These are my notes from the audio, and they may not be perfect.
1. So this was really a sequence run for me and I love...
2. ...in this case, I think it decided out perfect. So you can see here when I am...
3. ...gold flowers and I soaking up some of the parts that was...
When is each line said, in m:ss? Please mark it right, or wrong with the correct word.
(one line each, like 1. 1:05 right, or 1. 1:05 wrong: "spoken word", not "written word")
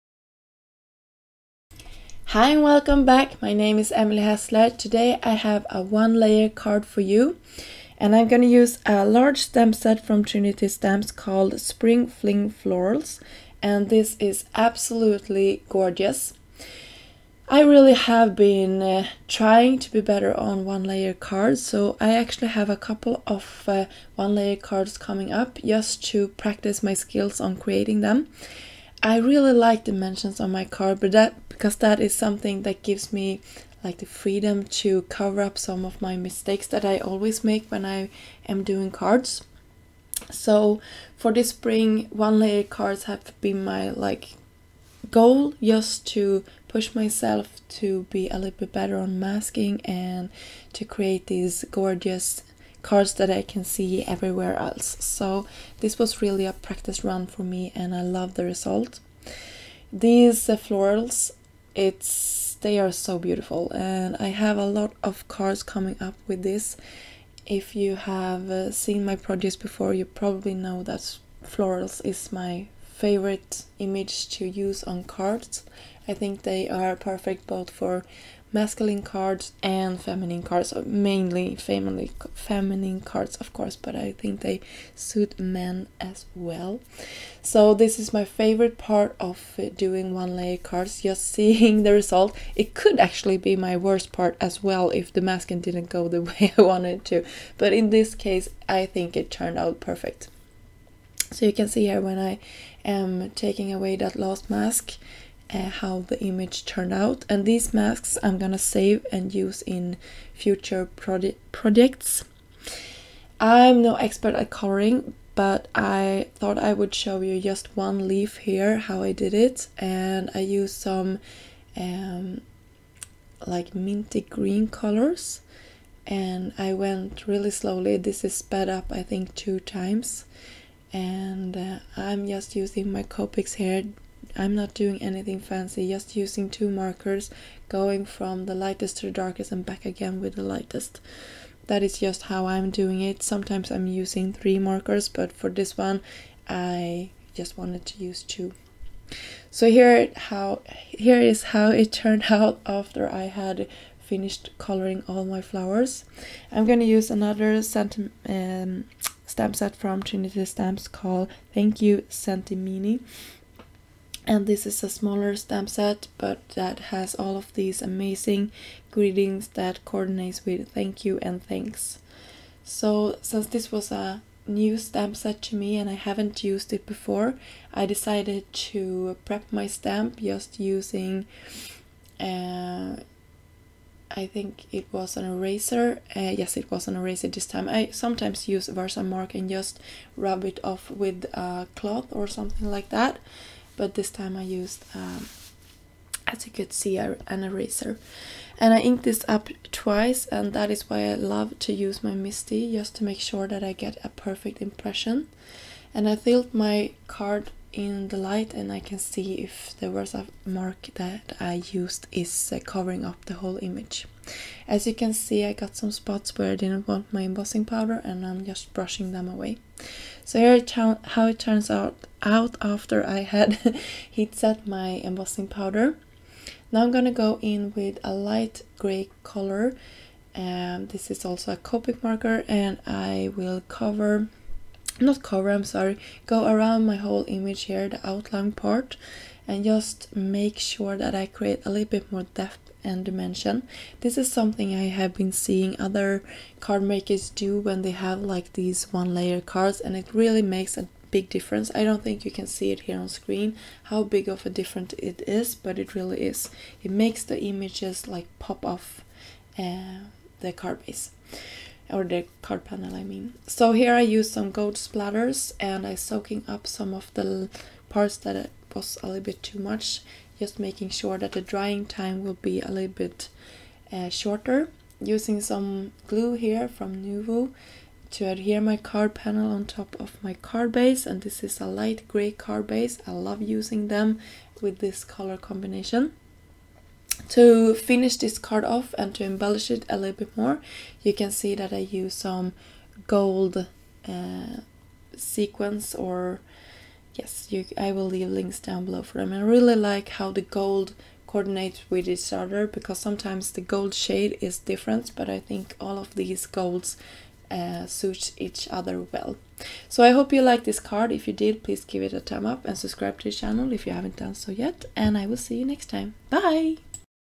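1. 0:54 wrong: "practice", not "sequence"
2. 1:37 wrong: "turned", not "decided"
3. 4:24 wrong: "splatters", not "flowers".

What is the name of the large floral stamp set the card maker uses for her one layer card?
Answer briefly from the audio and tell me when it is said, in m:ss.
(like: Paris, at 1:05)
Spring Fling Florals, at 0:11.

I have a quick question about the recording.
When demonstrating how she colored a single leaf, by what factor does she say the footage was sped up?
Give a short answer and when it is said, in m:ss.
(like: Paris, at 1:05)
2 times, at 2:09.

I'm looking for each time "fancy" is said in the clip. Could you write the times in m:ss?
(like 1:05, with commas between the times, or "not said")
2:15.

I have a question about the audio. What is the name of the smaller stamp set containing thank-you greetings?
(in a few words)
Thank You Senti-mini.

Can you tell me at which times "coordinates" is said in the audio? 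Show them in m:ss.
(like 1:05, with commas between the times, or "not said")
2:49, 5:01.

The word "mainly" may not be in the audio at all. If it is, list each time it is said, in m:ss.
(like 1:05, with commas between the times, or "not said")
1:20.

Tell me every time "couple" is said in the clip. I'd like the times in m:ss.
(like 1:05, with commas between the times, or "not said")
0:22.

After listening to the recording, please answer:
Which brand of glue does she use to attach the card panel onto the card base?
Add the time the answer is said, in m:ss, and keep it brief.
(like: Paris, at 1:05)
Nuvo, at 4:37.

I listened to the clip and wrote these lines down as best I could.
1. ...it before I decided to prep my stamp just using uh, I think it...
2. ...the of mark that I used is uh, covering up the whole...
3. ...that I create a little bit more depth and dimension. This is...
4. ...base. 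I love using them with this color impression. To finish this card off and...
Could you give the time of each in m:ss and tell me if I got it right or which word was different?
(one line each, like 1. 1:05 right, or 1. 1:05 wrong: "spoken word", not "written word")
1. 2:56 right
2. 3:29 right
3. 4:00 right
4. 4:42 wrong: "combination", not "impression".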